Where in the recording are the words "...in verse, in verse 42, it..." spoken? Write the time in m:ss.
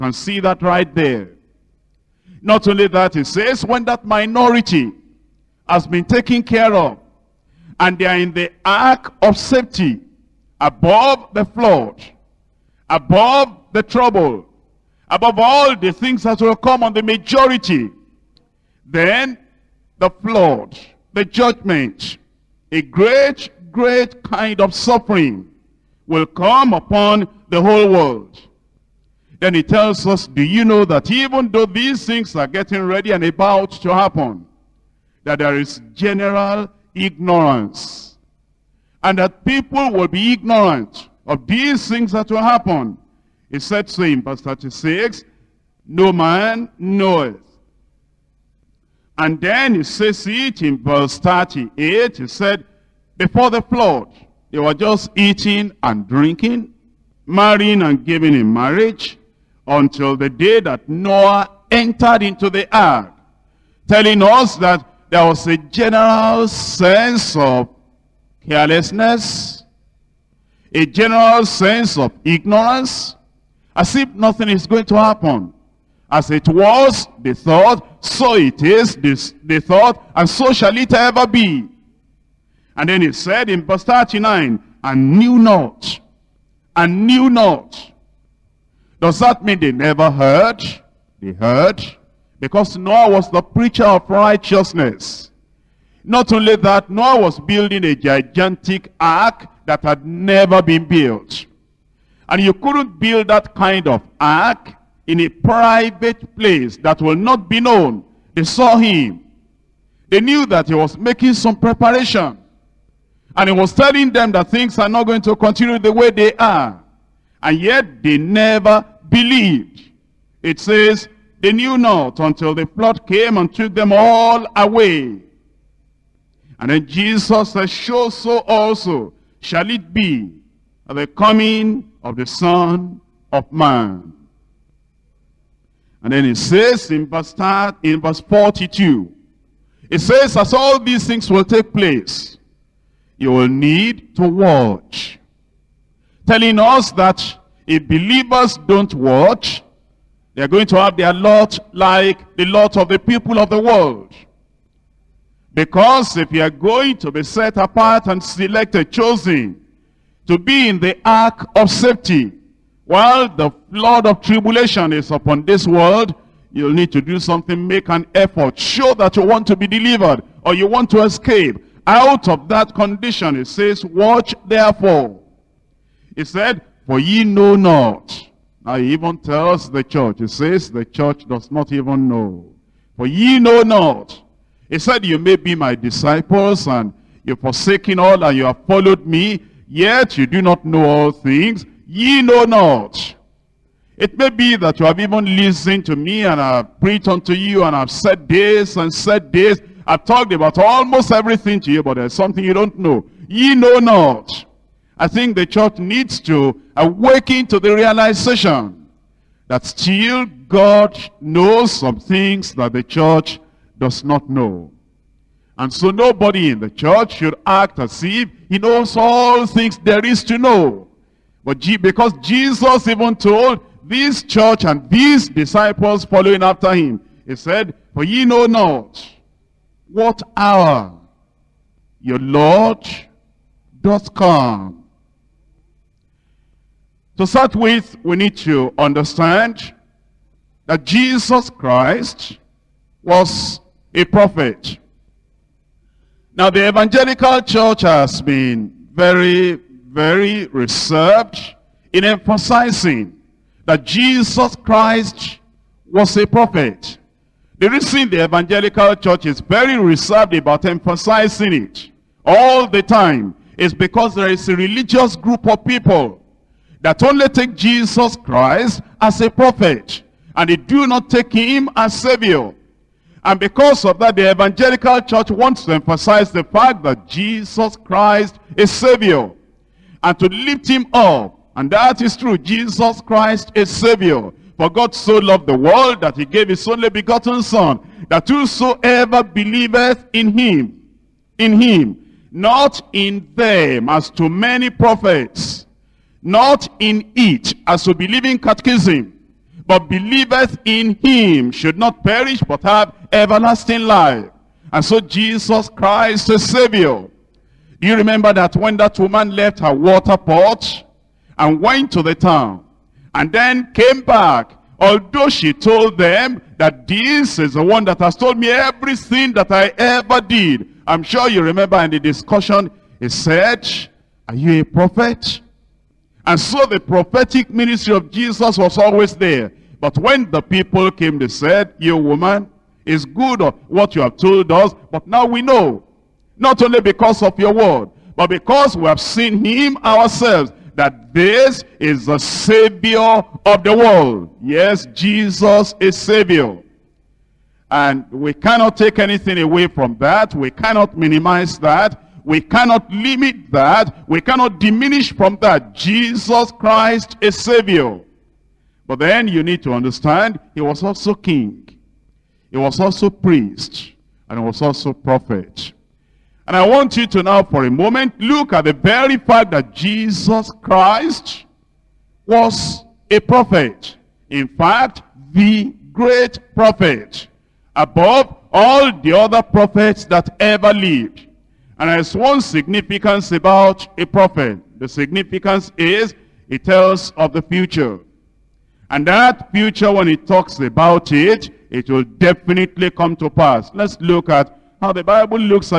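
2:16.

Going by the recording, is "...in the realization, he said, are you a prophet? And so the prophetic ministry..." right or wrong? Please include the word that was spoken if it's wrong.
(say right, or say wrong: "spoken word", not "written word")
wrong: "discussion", not "realization".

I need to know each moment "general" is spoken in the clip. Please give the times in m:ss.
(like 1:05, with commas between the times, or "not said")
0:35, 1:05, 1:10.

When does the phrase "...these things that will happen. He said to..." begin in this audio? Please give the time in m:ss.
0:41.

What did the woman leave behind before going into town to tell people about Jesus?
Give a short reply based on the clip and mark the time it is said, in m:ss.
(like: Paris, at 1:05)
her water pot, at 5:09.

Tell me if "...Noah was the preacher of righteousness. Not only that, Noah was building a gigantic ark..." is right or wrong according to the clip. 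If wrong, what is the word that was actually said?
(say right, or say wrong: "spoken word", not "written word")
right.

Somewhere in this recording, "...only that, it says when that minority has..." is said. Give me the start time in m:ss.
0:02.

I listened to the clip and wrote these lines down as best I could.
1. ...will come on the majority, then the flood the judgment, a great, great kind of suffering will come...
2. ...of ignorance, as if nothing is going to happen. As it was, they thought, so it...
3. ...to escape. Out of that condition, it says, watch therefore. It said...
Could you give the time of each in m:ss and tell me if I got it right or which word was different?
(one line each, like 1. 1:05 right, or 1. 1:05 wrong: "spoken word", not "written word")
1. 0:16 right
2. 1:11 right
3. 2:50 right.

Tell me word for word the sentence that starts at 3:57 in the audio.
To start with, we need to understand that Jesus Christ was a prophet.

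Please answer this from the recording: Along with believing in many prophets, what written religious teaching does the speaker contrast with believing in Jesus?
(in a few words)
catechism.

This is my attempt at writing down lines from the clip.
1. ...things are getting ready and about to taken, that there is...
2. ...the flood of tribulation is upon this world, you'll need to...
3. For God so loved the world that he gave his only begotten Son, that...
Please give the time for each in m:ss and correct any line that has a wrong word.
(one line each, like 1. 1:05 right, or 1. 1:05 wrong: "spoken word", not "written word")
1. 0:32 wrong: "happen", not "taken"
2. 2:43 right
3. 4:44 right.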